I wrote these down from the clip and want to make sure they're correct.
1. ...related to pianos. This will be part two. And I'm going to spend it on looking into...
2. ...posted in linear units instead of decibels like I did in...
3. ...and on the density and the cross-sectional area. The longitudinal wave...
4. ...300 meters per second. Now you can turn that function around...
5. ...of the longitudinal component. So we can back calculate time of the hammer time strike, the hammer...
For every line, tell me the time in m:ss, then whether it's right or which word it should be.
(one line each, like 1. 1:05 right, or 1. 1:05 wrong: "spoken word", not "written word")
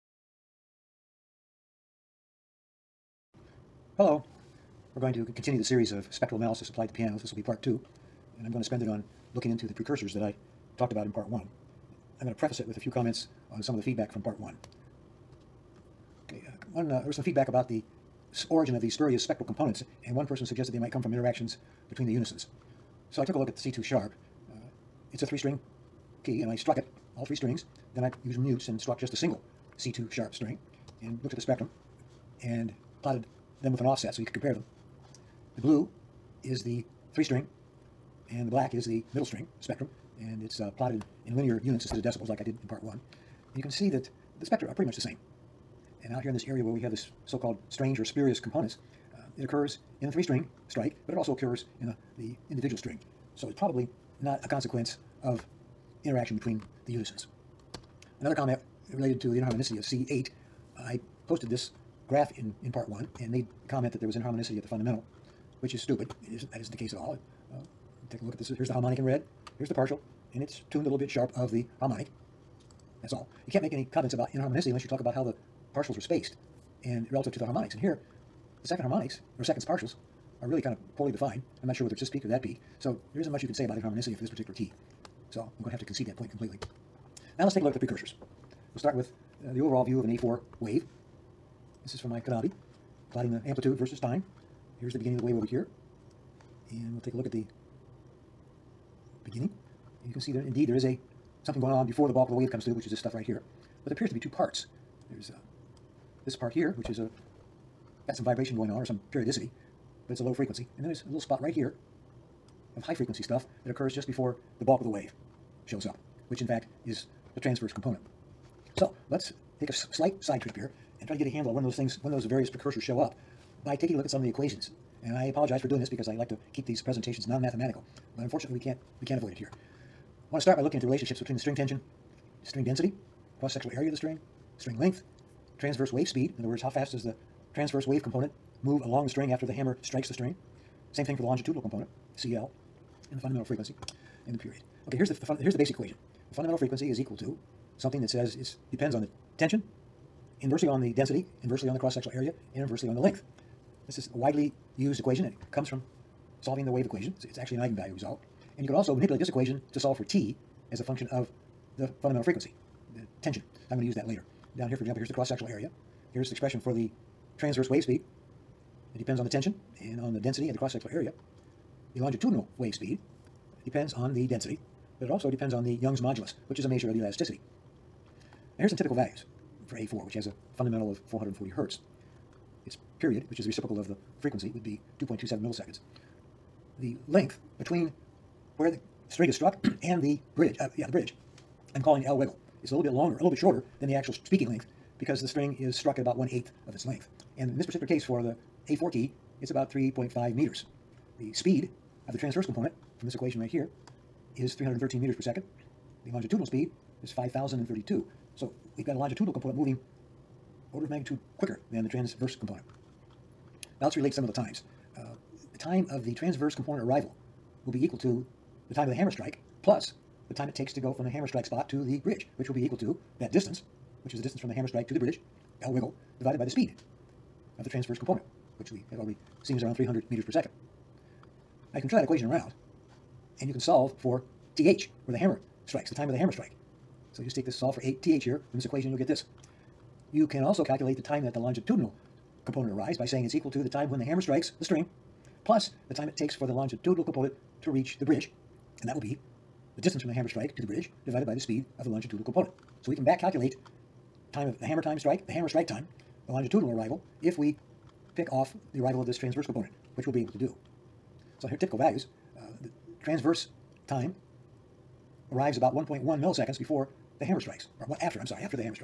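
1. 0:06 wrong: "applied", not "related"
2. 0:40 wrong: "plotted", not "posted"
3. 2:49 right
4. 3:49 wrong: "equation", not "function"
5. 4:11 right.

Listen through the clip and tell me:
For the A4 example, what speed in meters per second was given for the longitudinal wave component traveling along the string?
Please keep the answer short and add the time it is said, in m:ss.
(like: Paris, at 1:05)
5,032, at 3:27.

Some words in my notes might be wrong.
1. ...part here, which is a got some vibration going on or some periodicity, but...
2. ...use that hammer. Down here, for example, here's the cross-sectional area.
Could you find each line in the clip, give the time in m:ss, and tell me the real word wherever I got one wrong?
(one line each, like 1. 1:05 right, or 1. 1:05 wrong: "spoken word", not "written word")
1. 1:46 right
2. 2:43 wrong: "later", not "hammer".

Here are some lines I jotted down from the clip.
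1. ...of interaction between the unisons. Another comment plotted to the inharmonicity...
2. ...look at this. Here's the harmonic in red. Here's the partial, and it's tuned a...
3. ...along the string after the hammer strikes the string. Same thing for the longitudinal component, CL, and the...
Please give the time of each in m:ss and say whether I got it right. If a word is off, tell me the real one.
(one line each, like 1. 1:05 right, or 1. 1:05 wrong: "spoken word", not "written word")
1. 0:55 wrong: "related", not "plotted"
2. 1:08 right
3. 2:18 right.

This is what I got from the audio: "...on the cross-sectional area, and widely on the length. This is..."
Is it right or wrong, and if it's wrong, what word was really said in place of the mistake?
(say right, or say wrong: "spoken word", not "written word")
wrong: "inversely", not "widely".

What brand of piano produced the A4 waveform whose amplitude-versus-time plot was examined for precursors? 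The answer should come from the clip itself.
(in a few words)
Knabe.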